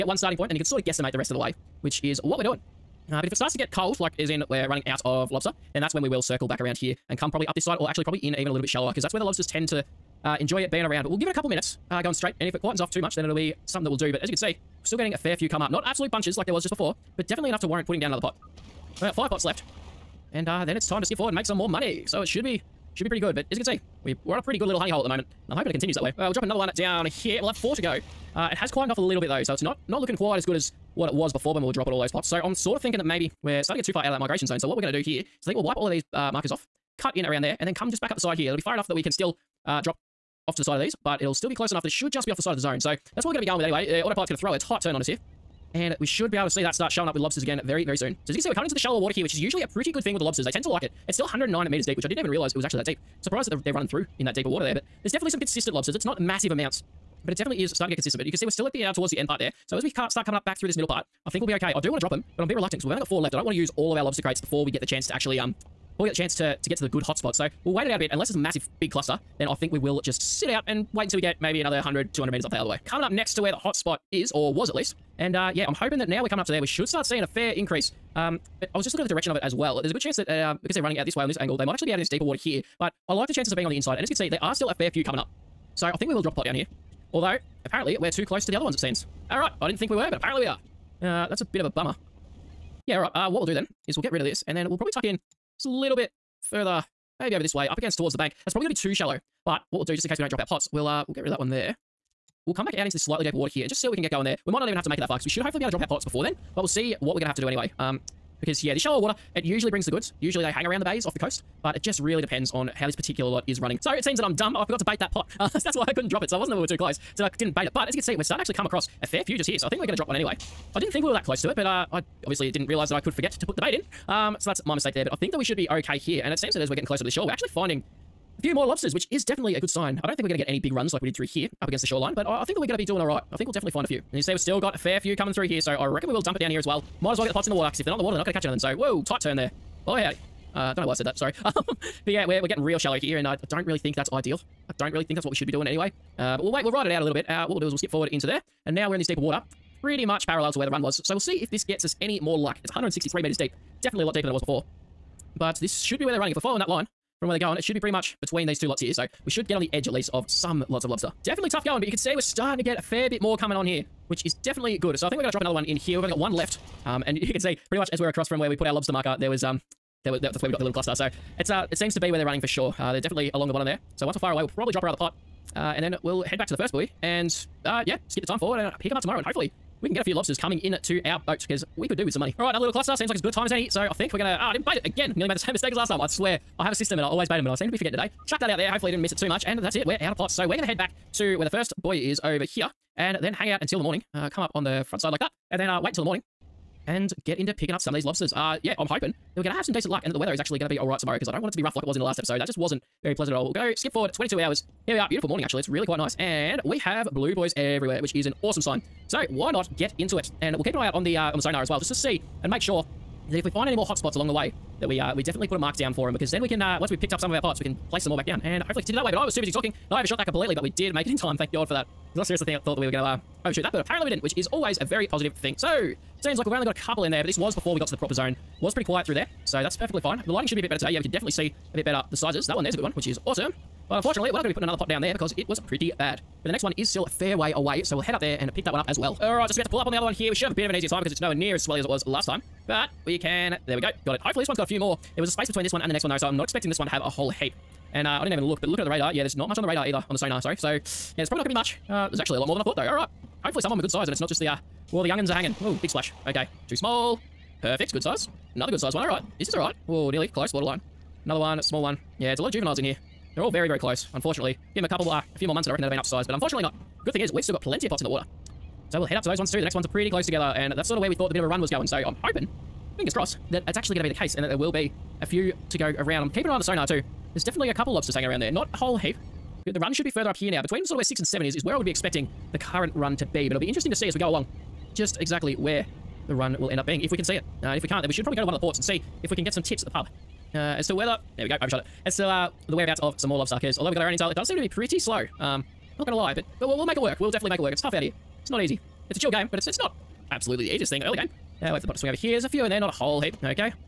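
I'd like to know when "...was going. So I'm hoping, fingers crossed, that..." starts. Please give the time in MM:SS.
04:31.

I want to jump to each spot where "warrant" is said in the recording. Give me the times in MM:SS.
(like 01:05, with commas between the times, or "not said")
00:17.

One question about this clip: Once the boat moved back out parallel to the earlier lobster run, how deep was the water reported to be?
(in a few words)
163 meters.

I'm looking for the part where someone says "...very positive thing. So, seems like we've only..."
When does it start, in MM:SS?
03:44.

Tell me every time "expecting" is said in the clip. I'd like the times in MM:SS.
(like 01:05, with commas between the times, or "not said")
04:06, 04:41.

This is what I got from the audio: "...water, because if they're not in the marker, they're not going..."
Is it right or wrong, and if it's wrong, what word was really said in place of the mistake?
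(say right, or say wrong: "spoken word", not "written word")
wrong: "water", not "marker".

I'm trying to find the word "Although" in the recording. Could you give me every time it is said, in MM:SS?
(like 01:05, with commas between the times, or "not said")
01:27, 04:53.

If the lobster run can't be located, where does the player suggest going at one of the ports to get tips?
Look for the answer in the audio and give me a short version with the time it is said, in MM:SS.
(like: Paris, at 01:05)
the pub, at 04:49.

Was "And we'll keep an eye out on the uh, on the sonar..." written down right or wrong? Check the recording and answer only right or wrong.
right.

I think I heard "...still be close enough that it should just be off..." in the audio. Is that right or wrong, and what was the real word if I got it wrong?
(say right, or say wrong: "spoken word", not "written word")
right.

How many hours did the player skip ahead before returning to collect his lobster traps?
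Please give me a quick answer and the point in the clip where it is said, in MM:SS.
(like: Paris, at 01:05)
22, at 03:24.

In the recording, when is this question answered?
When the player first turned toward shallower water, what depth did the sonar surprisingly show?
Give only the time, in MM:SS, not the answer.
00:51.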